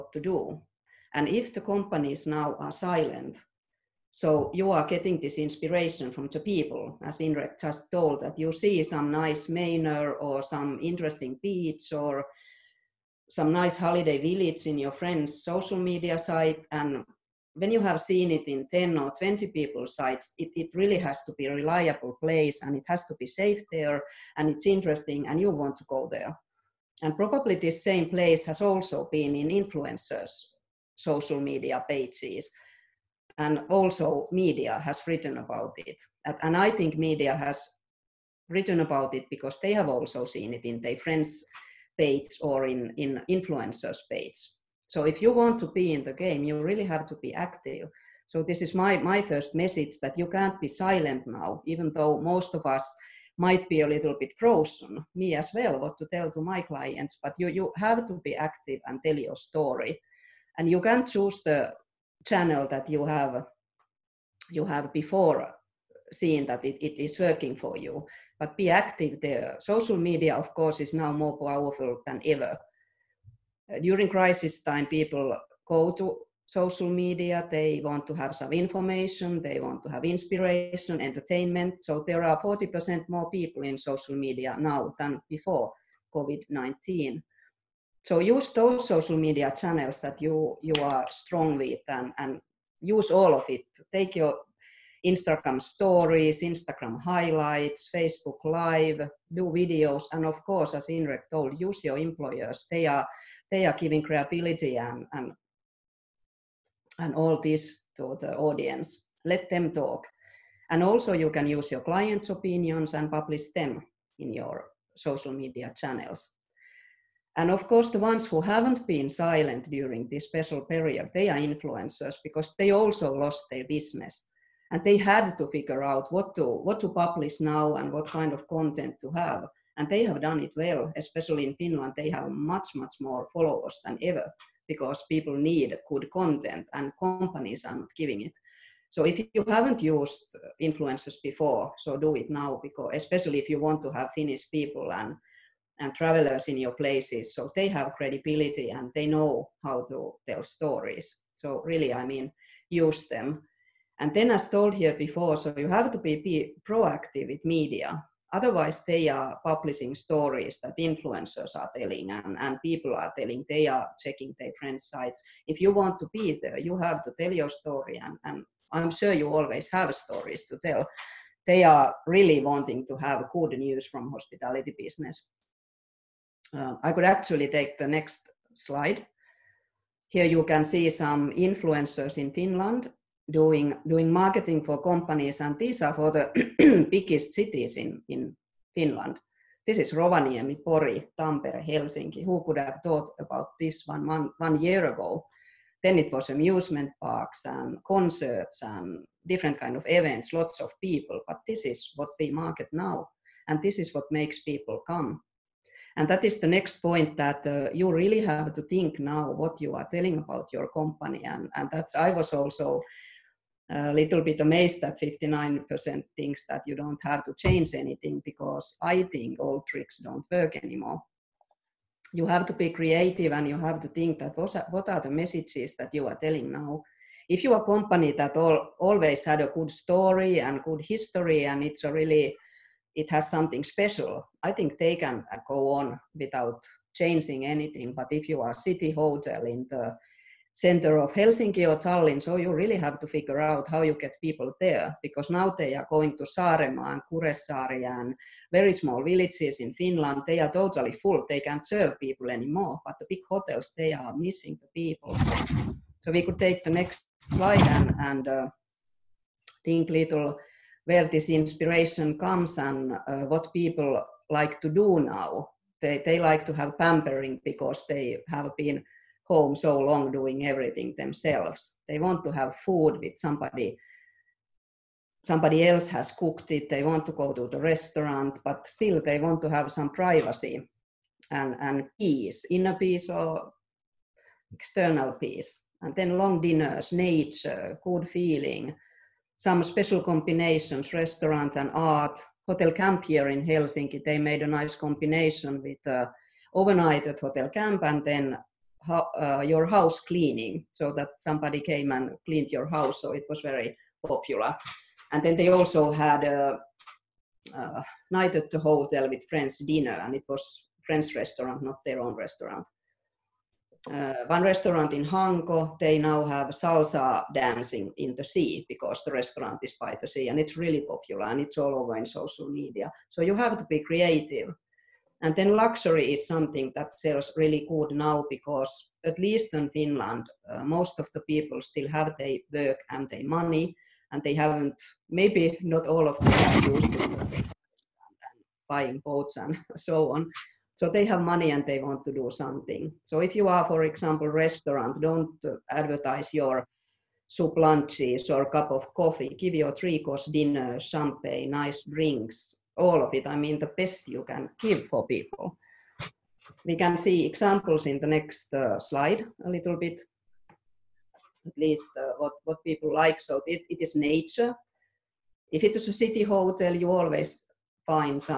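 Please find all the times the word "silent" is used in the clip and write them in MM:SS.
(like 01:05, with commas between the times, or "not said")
00:02, 00:50, 01:59.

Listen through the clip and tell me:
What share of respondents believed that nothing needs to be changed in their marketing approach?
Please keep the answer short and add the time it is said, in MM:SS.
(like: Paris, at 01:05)
59%, at 03:35.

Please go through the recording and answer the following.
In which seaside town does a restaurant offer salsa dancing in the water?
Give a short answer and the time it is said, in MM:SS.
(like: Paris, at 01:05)
Hanko, at 05:15.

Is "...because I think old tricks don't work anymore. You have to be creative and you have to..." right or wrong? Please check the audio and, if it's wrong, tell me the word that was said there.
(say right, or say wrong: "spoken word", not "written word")
right.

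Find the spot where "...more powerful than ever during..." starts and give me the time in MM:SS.
01:11.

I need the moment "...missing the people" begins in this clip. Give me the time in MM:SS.
04:14.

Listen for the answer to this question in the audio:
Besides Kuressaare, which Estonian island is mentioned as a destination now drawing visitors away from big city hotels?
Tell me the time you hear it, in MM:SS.
04:06.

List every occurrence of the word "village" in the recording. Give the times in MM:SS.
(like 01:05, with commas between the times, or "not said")
00:14, 04:09.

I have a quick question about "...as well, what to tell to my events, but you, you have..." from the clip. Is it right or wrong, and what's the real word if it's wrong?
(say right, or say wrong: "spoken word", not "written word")
wrong: "clients", not "events".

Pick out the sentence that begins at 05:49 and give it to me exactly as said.
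Give your three course dinner, champagne, nice drinks, all of it, I mean the best you can give for people.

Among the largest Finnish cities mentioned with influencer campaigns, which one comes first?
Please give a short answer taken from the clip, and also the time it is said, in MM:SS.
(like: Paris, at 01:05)
Rovaniemi, at 03:09.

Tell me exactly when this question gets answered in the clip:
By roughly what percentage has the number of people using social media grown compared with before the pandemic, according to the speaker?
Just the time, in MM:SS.
01:22.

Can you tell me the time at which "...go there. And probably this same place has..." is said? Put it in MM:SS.
00:25.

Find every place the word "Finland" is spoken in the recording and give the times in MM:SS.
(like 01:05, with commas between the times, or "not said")
02:11, 03:02, 03:08, 04:09, 05:29.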